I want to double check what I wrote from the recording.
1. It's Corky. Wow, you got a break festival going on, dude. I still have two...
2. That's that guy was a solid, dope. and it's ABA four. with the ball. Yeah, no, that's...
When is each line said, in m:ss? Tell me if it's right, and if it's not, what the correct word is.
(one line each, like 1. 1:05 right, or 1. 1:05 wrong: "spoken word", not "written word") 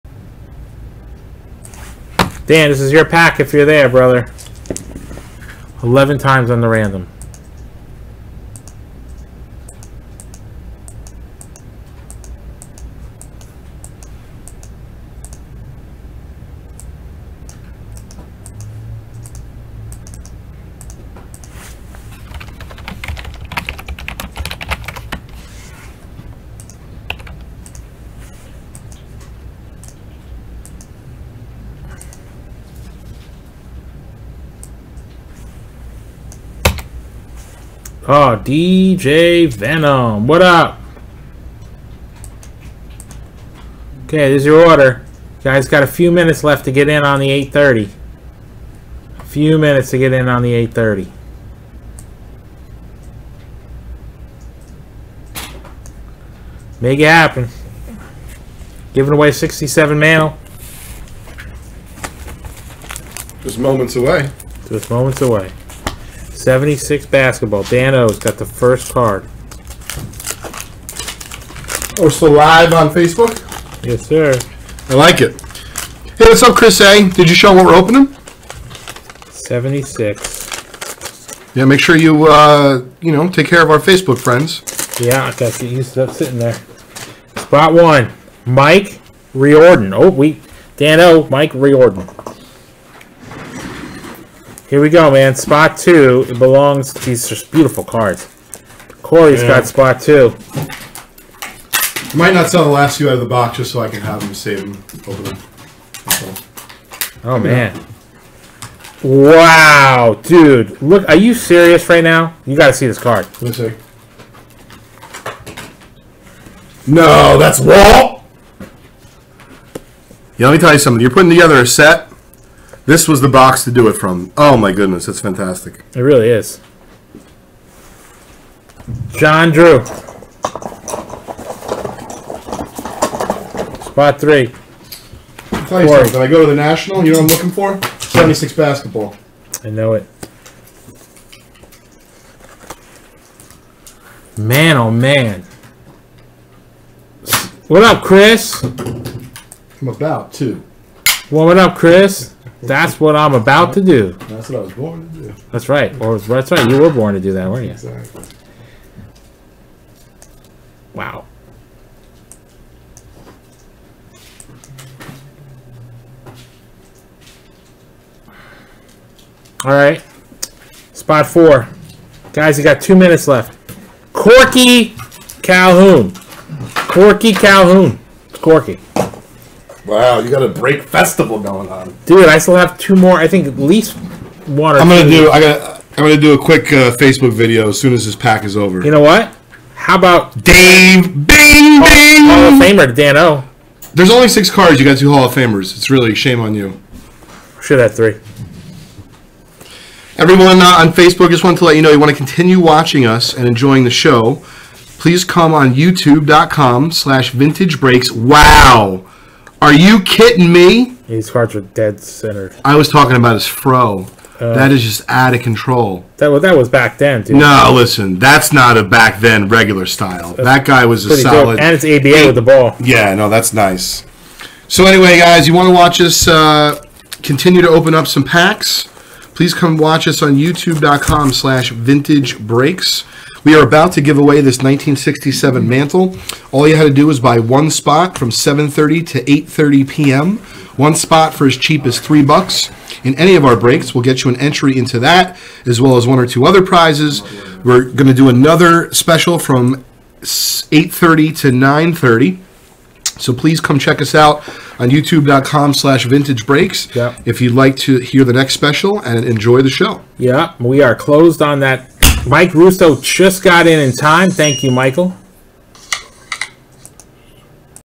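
1. 2:58 right
2. 3:40 wrong: "eight", not "four".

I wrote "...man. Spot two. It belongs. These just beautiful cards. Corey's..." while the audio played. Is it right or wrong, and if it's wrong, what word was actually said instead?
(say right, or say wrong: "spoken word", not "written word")
right.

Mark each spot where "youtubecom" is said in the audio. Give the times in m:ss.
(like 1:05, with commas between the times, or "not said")
3:25, 3:50, 4:14.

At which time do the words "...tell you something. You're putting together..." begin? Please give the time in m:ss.
2:00.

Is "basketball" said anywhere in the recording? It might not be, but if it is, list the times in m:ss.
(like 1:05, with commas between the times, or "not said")
1:07, 2:18.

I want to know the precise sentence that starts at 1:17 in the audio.
Did you show what we're opening?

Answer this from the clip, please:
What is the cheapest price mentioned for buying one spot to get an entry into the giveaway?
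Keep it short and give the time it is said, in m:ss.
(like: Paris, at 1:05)
$3, at 4:01.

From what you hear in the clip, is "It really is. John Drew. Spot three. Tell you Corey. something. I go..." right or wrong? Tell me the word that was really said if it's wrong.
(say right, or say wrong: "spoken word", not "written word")
right.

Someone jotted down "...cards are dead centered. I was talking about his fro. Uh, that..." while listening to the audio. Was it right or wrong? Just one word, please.
right.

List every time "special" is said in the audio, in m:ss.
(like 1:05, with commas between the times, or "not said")
4:08, 4:18.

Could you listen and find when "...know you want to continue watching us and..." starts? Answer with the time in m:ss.
3:21.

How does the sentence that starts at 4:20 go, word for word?
Yeah, we are closed on that Mike Russo just got in in time.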